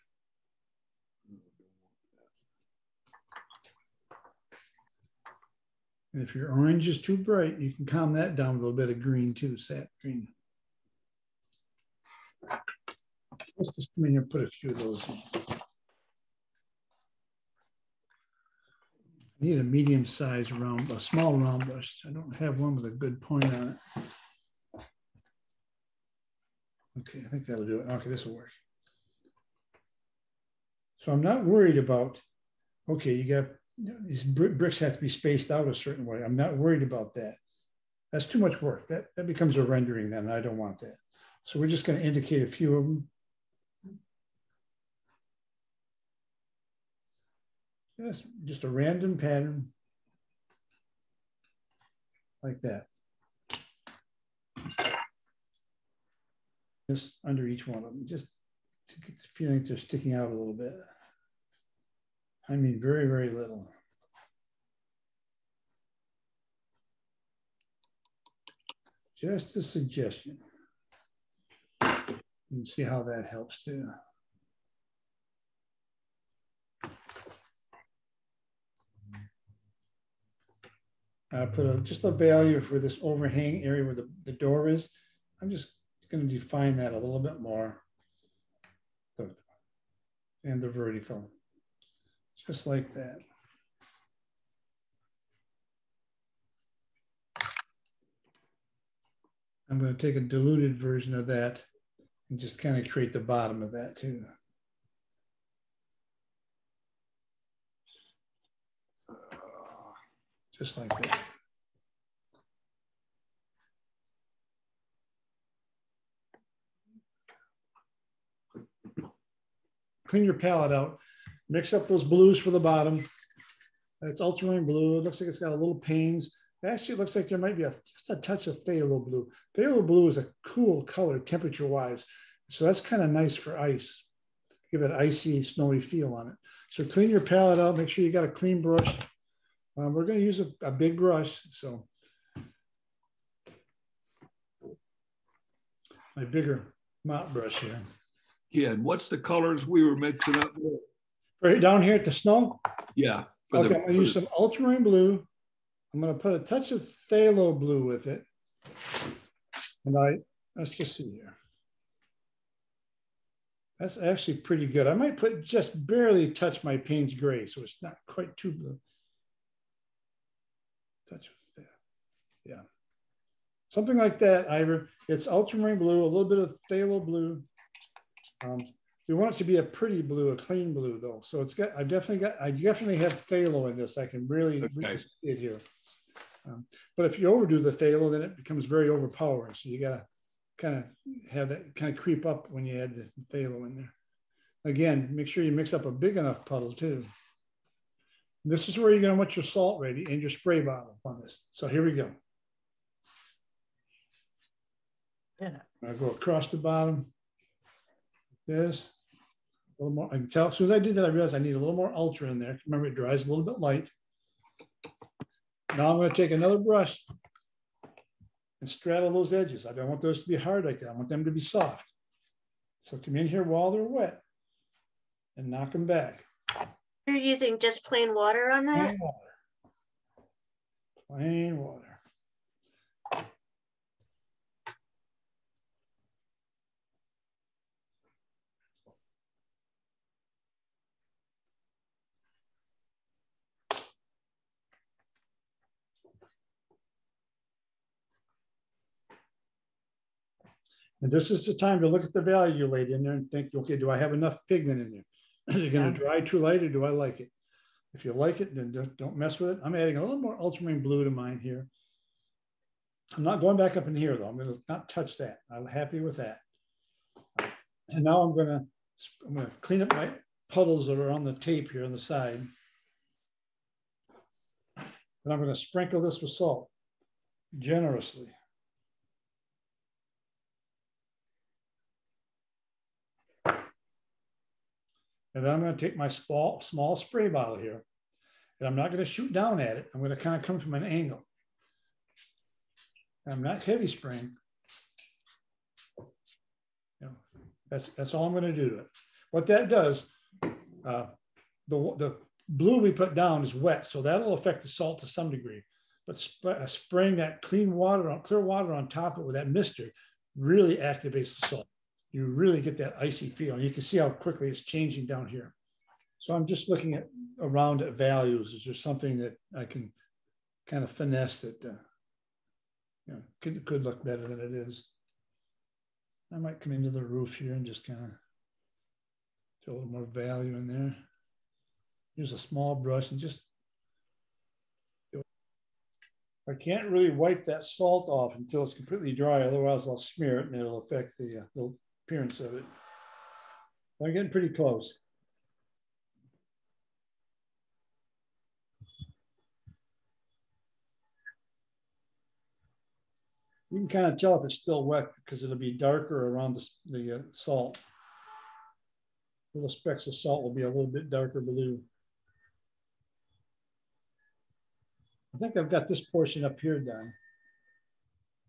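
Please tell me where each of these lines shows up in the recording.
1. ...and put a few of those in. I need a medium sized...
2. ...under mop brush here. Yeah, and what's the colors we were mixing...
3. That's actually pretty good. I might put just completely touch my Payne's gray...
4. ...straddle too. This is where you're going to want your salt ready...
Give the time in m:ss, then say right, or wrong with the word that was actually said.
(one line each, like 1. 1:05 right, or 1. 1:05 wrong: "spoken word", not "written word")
1. 0:14 right
2. 2:26 wrong: "bigger", not "under"
3. 2:43 wrong: "barely", not "completely"
4. 3:16 wrong: "puddle", not "straddle".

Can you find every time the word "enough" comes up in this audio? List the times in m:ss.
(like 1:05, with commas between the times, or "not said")
3:16, 4:14.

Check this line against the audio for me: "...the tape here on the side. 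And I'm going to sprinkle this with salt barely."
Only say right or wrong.
wrong.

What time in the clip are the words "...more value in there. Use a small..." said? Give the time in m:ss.
5:29.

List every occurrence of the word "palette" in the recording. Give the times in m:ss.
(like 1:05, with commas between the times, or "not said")
2:00, 2:17.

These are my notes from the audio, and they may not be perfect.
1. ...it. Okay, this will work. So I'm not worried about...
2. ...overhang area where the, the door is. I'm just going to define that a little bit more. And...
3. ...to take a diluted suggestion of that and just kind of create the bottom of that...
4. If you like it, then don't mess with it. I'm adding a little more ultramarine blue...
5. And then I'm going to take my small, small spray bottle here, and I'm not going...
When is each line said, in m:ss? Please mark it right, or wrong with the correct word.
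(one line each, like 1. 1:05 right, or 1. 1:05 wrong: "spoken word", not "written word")
1. 0:27 right
2. 1:23 right
3. 1:39 wrong: "version", not "suggestion"
4. 4:17 right
5. 4:45 right.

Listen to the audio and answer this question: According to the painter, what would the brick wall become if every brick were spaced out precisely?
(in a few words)
A rendering.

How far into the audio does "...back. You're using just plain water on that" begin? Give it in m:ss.
3:45.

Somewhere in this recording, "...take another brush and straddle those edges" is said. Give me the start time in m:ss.
3:36.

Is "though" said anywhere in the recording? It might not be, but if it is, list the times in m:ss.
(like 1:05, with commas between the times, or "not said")
3:00, 4:24.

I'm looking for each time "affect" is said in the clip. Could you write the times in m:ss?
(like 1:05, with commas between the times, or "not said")
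5:04, 5:40.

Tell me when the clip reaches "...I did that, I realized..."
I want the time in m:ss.
3:30.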